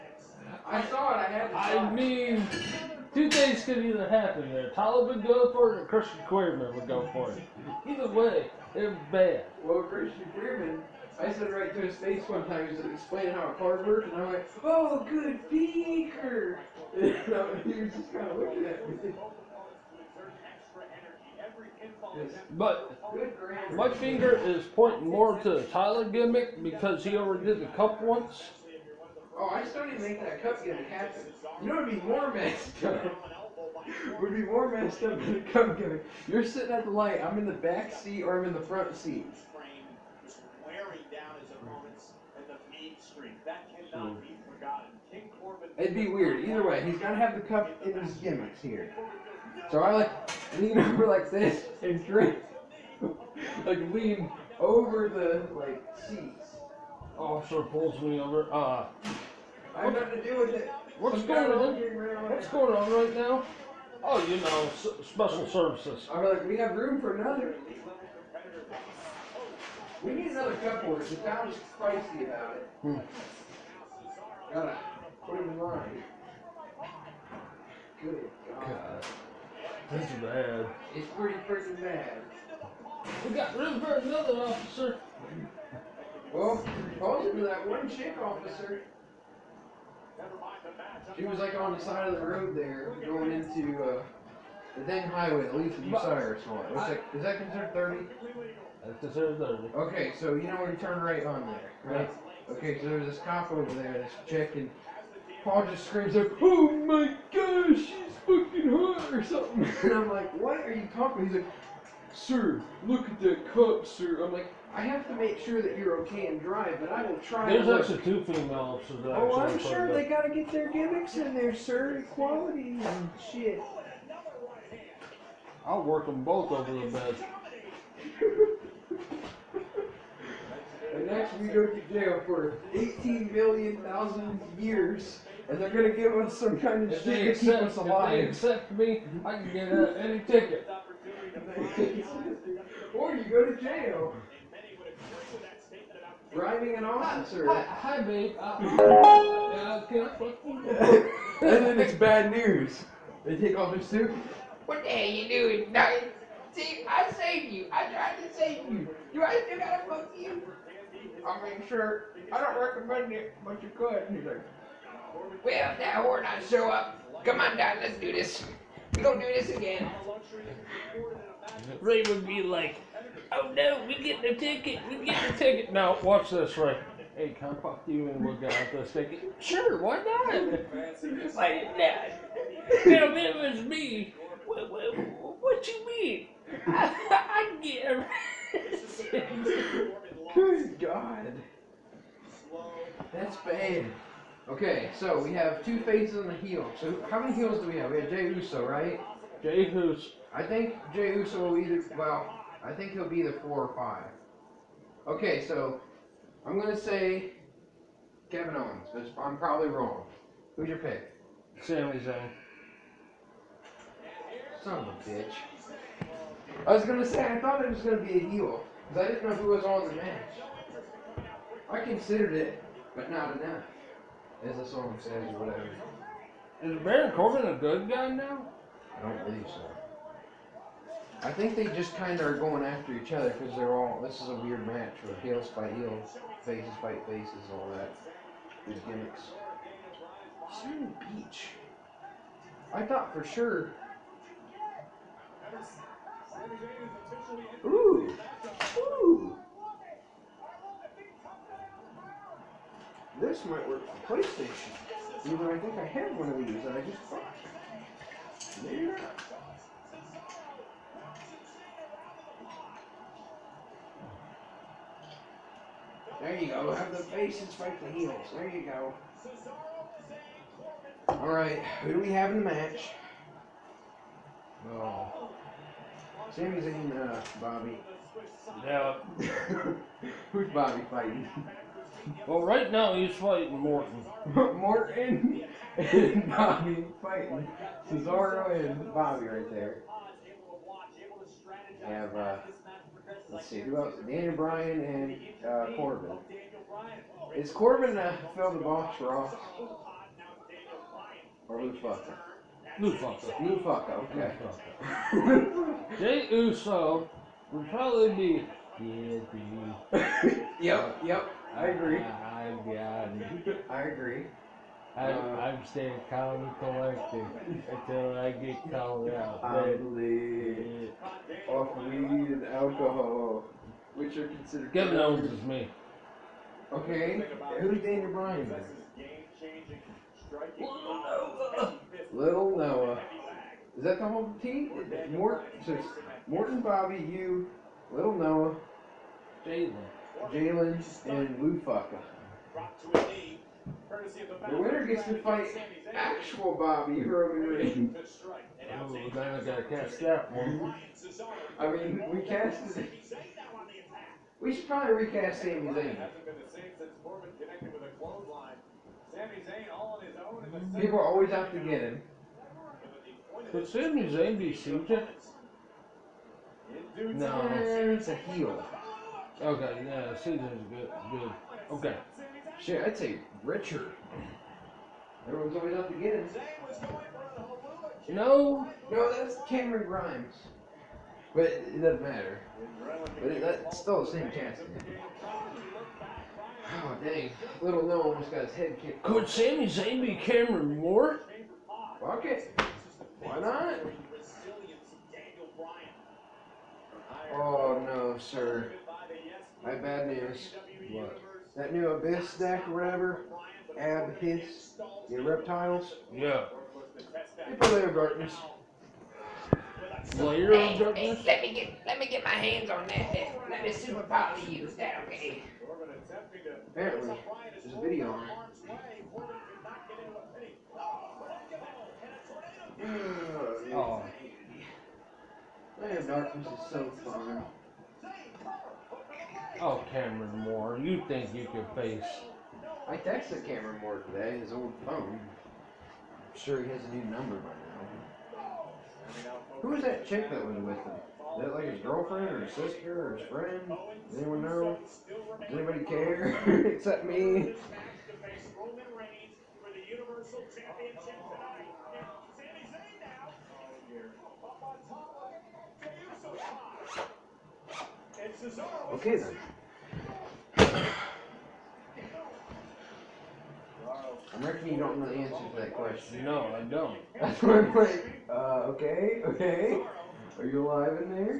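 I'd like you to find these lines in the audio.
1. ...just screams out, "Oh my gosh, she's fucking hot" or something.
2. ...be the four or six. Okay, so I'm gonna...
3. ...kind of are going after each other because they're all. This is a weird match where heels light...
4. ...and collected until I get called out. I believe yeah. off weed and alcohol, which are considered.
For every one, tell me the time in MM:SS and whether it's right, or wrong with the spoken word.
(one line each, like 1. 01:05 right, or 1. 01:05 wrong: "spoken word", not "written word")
1. 01:45 right
2. 03:23 wrong: "five", not "six"
3. 03:51 wrong: "fight", not "light"
4. 05:16 right.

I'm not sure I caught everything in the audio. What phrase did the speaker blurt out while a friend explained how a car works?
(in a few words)
Oh, good beaker.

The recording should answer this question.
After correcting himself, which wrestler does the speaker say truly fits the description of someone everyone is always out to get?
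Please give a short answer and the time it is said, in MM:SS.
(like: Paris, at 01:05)
Cameron Grimes, at 06:19.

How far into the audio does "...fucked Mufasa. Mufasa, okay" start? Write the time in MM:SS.
05:01.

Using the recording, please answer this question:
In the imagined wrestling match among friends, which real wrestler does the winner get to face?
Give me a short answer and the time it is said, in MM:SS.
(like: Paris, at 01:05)
Roman Reigns, at 05:47.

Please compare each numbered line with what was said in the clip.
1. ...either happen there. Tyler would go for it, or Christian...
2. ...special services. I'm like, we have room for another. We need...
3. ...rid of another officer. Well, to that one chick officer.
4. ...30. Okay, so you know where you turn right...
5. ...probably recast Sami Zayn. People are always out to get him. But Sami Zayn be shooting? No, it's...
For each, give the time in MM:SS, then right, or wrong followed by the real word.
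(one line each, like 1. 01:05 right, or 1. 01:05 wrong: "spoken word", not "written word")
1. 00:03 right
2. 01:05 right
3. 01:23 right
4. 01:39 right
5. 05:54 right.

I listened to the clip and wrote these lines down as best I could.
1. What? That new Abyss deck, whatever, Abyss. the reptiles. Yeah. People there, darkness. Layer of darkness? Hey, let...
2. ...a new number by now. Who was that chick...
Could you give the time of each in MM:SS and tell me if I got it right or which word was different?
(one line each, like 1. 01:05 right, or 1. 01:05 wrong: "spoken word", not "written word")
1. 06:40 right
2. 07:16 right.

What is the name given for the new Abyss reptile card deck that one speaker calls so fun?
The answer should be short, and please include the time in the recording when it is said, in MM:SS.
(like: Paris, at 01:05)
Land of Darkness, at 07:05.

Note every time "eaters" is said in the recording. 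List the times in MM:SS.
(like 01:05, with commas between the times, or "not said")
not said.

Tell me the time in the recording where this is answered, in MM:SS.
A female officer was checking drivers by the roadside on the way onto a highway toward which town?
01:35.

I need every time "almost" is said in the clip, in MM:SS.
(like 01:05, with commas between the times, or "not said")
06:28.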